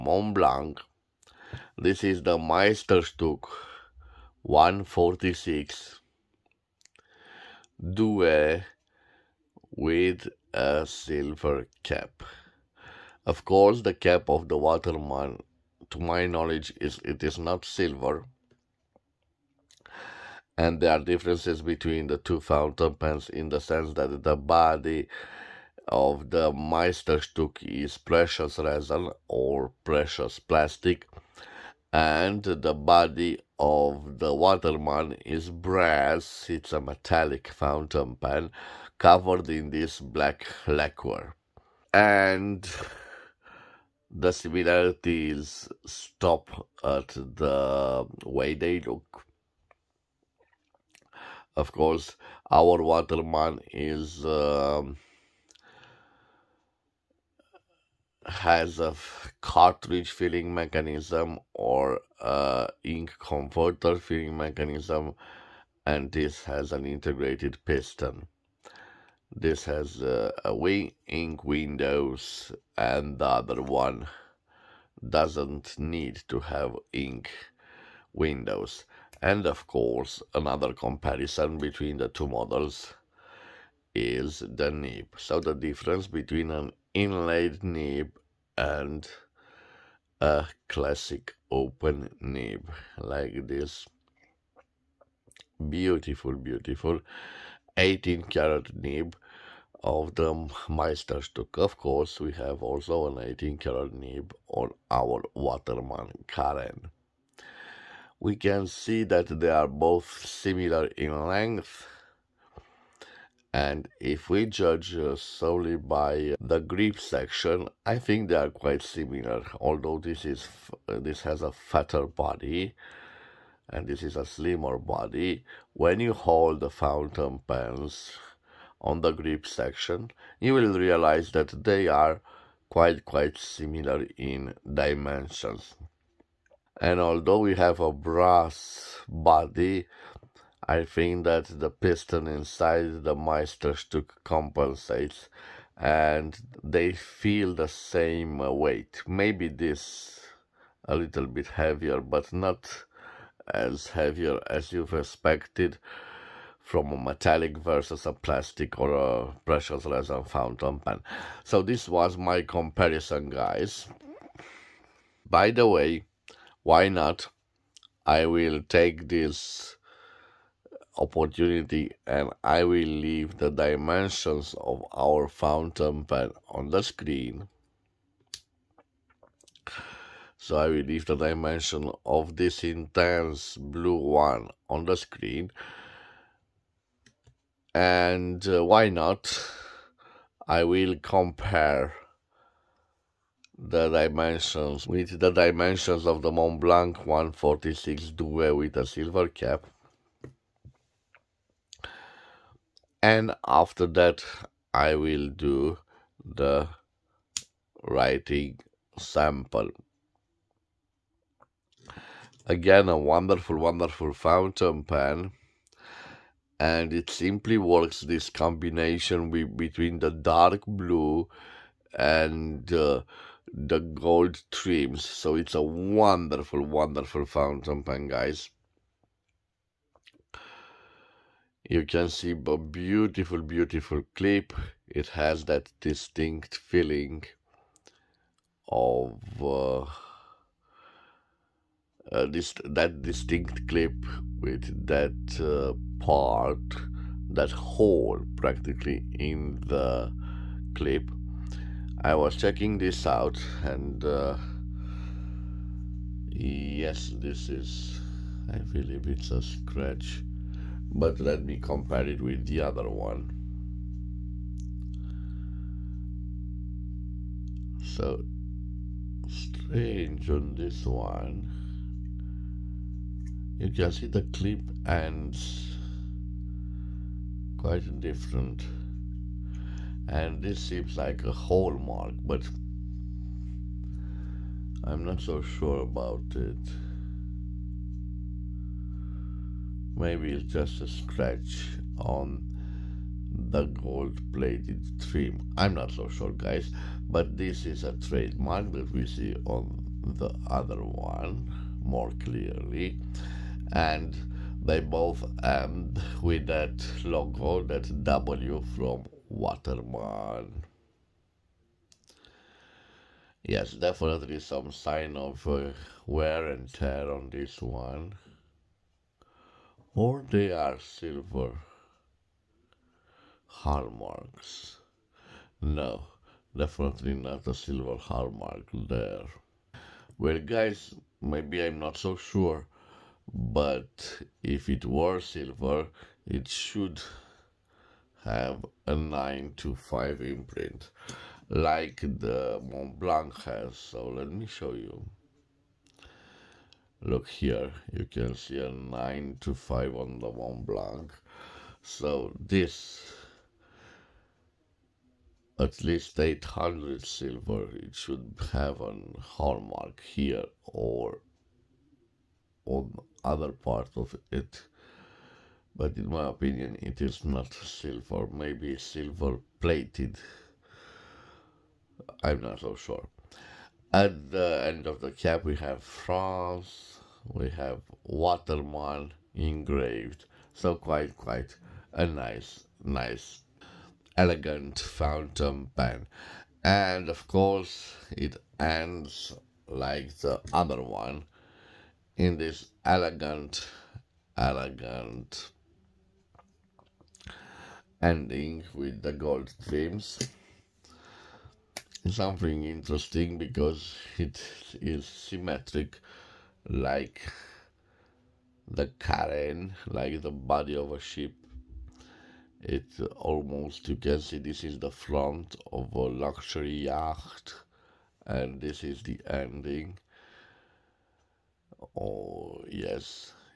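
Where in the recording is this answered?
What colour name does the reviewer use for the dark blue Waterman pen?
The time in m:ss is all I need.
3:02.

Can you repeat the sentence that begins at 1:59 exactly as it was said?
Although this is uh, this has a fatter body, and this is a slimmer body.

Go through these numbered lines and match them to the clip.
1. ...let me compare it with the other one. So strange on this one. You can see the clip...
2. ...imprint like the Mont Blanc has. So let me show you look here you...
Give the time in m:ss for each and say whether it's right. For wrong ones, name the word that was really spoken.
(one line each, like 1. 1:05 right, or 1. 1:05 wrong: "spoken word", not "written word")
1. 4:21 right
2. 5:40 right.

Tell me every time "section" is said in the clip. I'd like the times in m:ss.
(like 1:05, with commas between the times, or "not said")
1:56, 2:09.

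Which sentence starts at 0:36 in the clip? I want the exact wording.
It's a metallic fountain pen covered in this black lacquer.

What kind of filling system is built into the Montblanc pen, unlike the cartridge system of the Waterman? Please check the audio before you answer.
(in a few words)
Integrated piston.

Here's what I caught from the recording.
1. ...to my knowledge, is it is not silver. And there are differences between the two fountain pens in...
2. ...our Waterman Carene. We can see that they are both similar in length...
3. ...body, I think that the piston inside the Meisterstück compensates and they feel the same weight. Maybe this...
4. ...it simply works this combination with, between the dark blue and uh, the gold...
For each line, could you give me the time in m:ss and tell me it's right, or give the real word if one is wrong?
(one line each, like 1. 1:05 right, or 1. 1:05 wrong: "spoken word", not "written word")
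1. 0:15 right
2. 1:44 right
3. 2:19 right
4. 3:37 right.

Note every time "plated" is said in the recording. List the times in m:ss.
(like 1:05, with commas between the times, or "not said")
4:54, 6:09.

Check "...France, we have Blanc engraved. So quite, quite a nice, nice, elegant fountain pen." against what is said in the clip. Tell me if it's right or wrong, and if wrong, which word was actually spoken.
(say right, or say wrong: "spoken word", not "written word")
wrong: "Waterman", not "Blanc".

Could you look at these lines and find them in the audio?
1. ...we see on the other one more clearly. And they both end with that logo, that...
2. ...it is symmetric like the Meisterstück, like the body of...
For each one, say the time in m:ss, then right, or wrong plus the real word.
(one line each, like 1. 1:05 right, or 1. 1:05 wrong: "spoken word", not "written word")
1. 4:58 right
2. 6:44 wrong: "Carene", not "Meisterstück".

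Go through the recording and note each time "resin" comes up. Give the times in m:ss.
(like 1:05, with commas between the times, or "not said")
0:28, 2:39.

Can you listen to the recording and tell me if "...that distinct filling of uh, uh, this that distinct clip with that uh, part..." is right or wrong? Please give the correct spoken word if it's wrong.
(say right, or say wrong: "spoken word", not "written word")
wrong: "feeling", not "filling".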